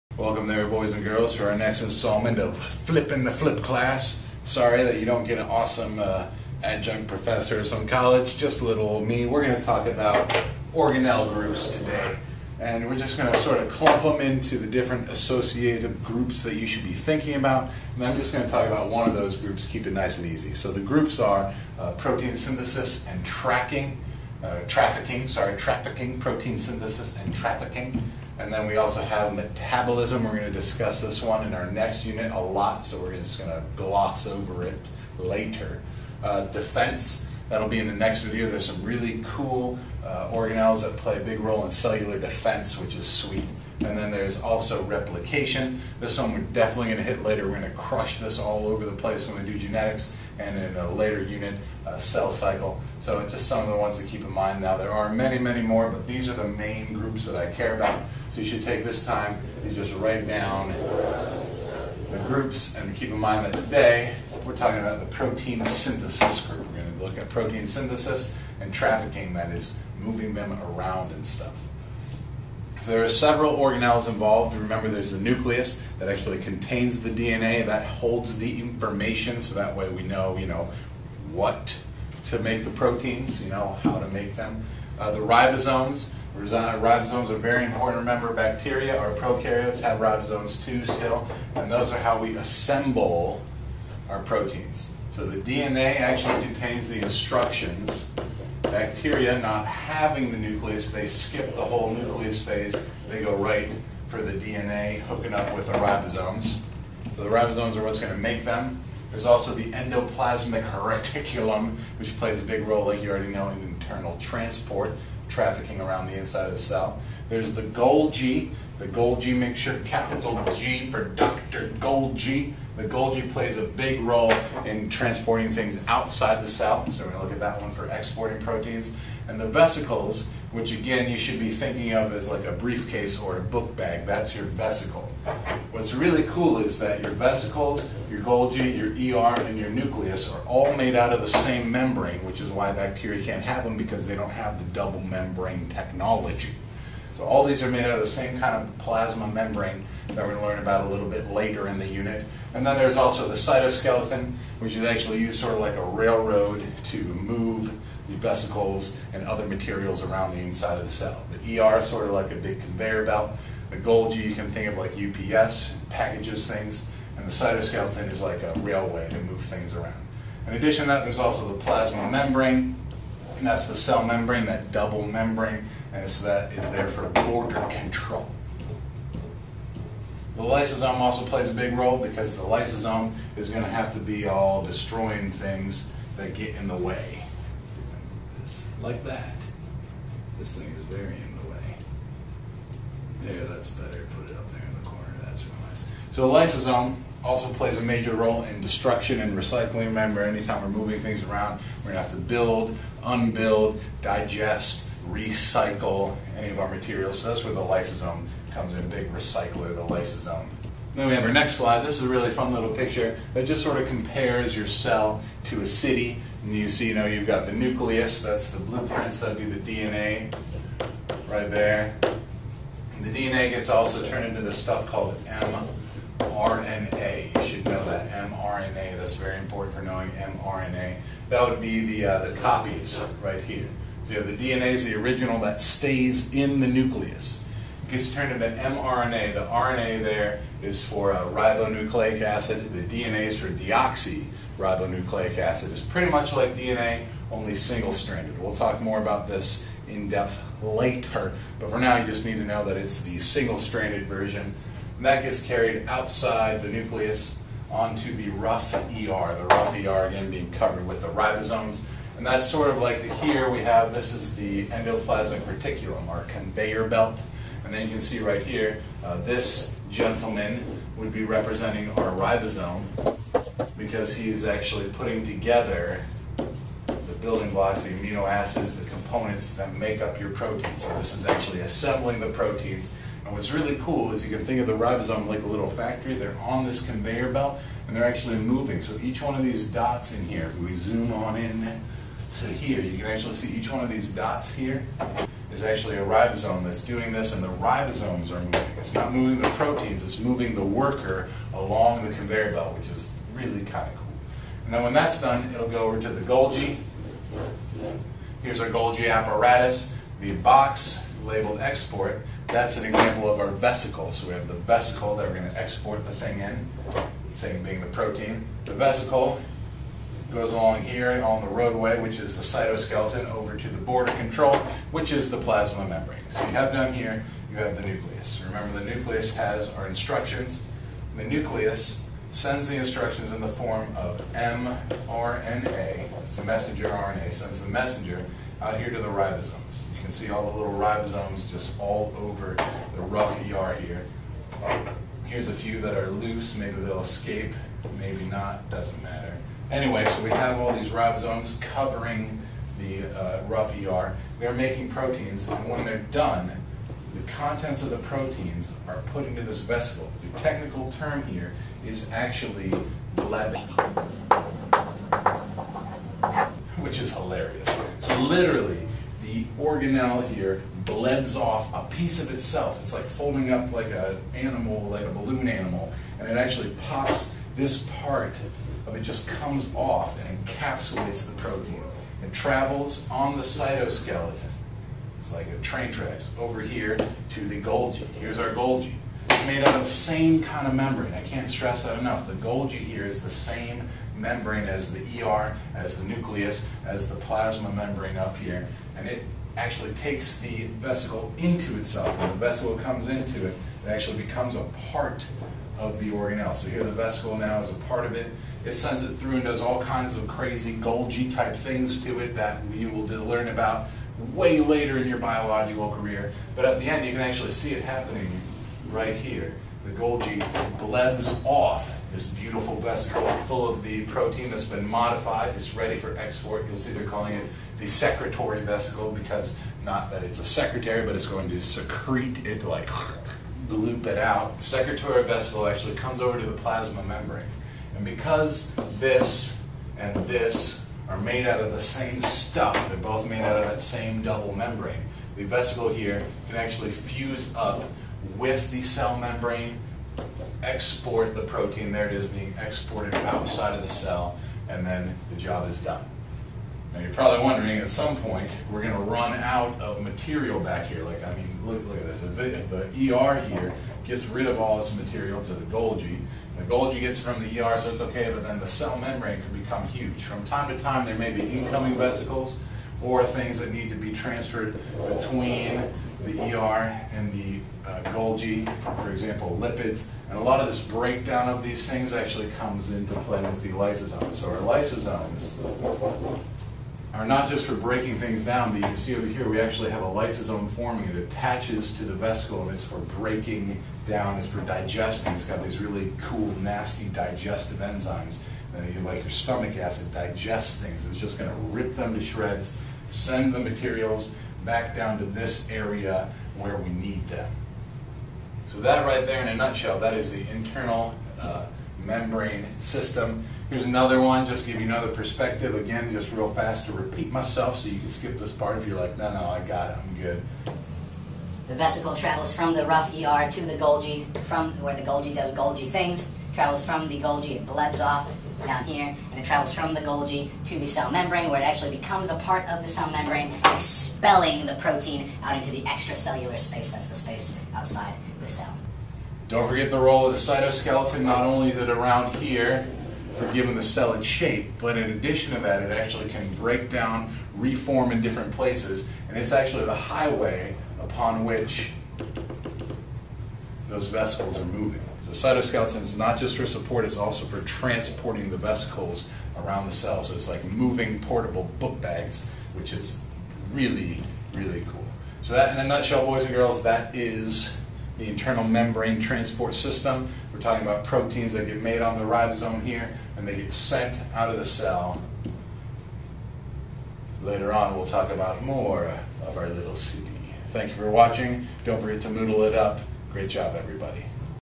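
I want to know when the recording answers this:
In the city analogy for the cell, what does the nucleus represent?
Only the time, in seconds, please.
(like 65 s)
218 s.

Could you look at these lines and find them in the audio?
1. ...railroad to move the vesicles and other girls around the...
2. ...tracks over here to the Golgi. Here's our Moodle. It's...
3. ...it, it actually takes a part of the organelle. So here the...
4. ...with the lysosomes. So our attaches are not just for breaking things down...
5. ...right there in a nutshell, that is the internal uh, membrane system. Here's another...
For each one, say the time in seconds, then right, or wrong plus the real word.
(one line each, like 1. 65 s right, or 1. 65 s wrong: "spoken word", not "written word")
1. 155 s wrong: "materials", not "girls"
2. 385 s wrong: "Golgi", not "Moodle"
3. 403 s wrong: "becomes", not "takes"
4. 483 s wrong: "lysosomes", not "attaches"
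5. 509 s right.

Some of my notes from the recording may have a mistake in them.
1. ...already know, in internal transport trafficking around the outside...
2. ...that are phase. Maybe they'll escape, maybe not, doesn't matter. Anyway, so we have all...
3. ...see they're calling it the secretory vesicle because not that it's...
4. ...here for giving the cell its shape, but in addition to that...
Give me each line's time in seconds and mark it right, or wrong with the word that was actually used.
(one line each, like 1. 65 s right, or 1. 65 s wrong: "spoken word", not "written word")
1. 113 s wrong: "inside", not "outside"
2. 345 s wrong: "loose", not "phase"
3. 426 s right
4. 542 s right.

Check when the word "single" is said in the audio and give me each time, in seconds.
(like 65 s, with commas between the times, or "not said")
247 s, 253 s.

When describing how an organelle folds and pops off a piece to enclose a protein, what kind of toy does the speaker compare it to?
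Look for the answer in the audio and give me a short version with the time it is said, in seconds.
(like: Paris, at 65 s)
A balloon animal, at 375 s.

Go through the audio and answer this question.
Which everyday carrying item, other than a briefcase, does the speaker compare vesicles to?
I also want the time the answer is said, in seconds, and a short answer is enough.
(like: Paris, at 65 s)
A book bag, at 133 s.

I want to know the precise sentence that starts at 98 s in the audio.
Bacteria, not having the nucleus, they skip the whole nucleus phase.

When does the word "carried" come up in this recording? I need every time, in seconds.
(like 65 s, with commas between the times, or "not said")
255 s.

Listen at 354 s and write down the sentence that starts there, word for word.
They're making proteins, and when they're done, the contents of the proteins are put into this vesicle.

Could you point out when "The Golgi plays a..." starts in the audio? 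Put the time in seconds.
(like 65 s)
122 s.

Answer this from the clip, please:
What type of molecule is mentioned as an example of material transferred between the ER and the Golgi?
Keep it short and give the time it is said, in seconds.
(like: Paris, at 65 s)
Lipids, at 479 s.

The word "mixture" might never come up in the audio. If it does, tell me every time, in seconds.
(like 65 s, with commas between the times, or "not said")
119 s.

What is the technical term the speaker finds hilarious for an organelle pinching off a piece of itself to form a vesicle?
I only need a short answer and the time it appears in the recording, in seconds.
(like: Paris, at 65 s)
Blebbing, at 363 s.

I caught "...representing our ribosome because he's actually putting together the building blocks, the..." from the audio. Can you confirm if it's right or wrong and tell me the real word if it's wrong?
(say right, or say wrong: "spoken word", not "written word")
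right.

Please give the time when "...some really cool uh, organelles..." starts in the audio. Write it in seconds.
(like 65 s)
38 s.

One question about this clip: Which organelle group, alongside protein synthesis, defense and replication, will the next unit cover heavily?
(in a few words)
Metabolism.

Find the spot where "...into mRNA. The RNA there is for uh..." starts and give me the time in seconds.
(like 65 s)
238 s.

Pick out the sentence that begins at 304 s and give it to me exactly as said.
And then when that's done, it'll go over to the Golgi.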